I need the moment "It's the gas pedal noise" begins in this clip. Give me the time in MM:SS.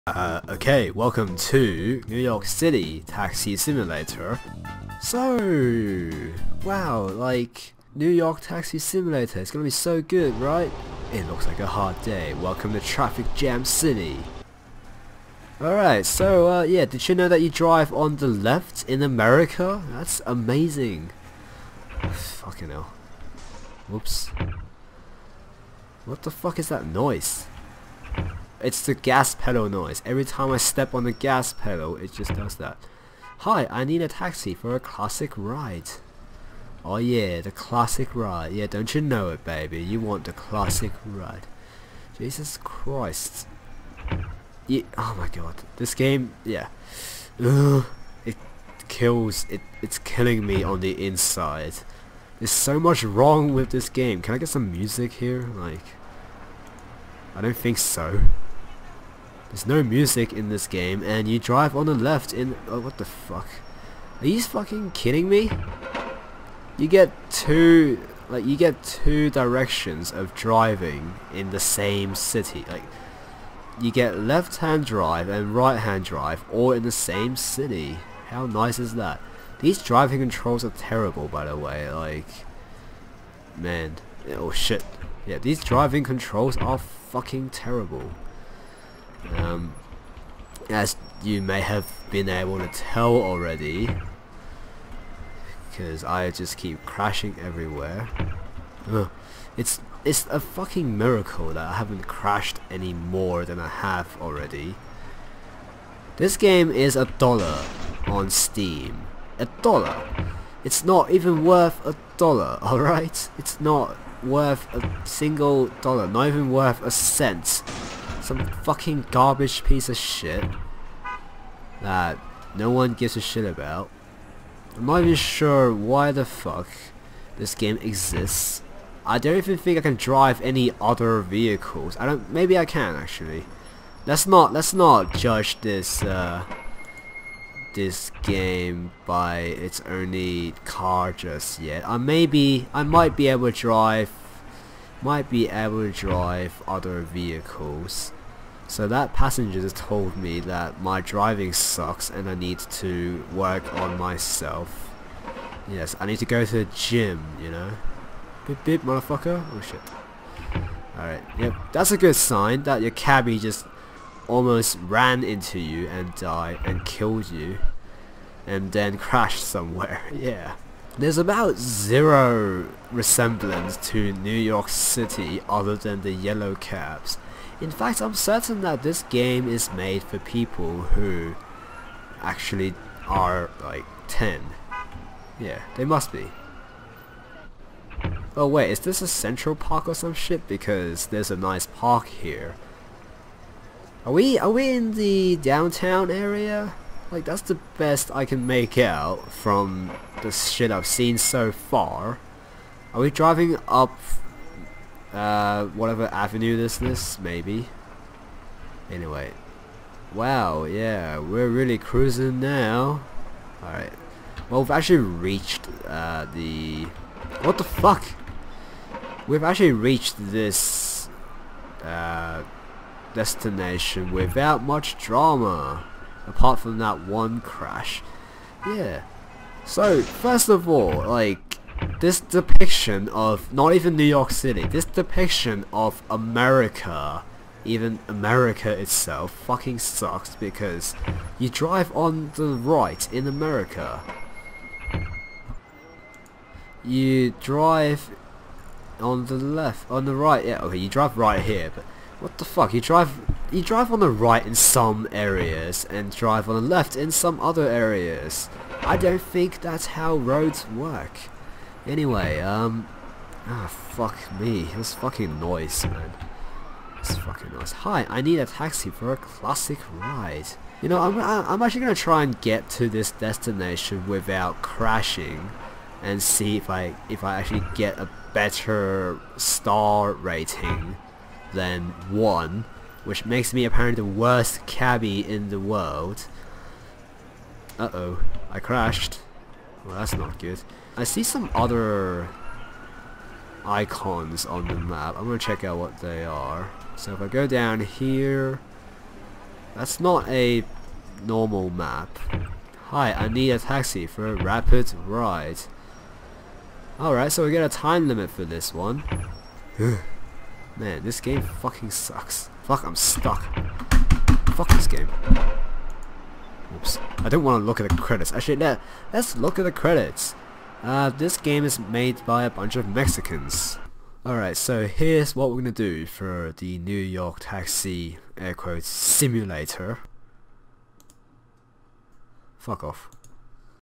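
00:28.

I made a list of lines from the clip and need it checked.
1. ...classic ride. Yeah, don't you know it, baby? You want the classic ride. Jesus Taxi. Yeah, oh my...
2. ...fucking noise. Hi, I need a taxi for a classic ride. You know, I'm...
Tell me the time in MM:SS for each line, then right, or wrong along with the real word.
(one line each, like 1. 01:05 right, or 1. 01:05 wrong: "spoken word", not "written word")
1. 00:37 wrong: "Christ", not "Taxi"
2. 04:27 right.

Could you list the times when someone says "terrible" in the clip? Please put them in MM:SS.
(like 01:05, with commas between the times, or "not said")
01:20, 01:27.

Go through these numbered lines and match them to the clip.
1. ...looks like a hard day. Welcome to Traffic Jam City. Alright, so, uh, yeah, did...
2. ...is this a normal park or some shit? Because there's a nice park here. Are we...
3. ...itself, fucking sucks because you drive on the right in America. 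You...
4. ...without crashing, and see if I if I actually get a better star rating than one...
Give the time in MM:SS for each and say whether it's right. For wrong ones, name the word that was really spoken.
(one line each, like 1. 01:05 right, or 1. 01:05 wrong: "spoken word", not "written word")
1. 00:11 right
2. 03:08 wrong: "central", not "normal"
3. 03:58 right
4. 04:34 right.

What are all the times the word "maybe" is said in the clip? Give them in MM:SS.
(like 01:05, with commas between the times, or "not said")
02:12, 02:21, 03:27.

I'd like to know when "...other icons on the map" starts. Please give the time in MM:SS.
04:51.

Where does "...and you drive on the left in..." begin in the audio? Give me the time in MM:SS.
01:01.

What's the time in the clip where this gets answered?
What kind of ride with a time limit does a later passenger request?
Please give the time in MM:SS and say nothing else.
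05:04.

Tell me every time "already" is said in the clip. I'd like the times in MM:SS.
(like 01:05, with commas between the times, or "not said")
01:33, 01:44.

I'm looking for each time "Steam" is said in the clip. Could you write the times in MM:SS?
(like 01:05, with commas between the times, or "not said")
01:48.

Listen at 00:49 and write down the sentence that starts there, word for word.
It, it's killing me on the inside.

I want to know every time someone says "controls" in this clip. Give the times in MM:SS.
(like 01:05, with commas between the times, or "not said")
01:20, 01:26.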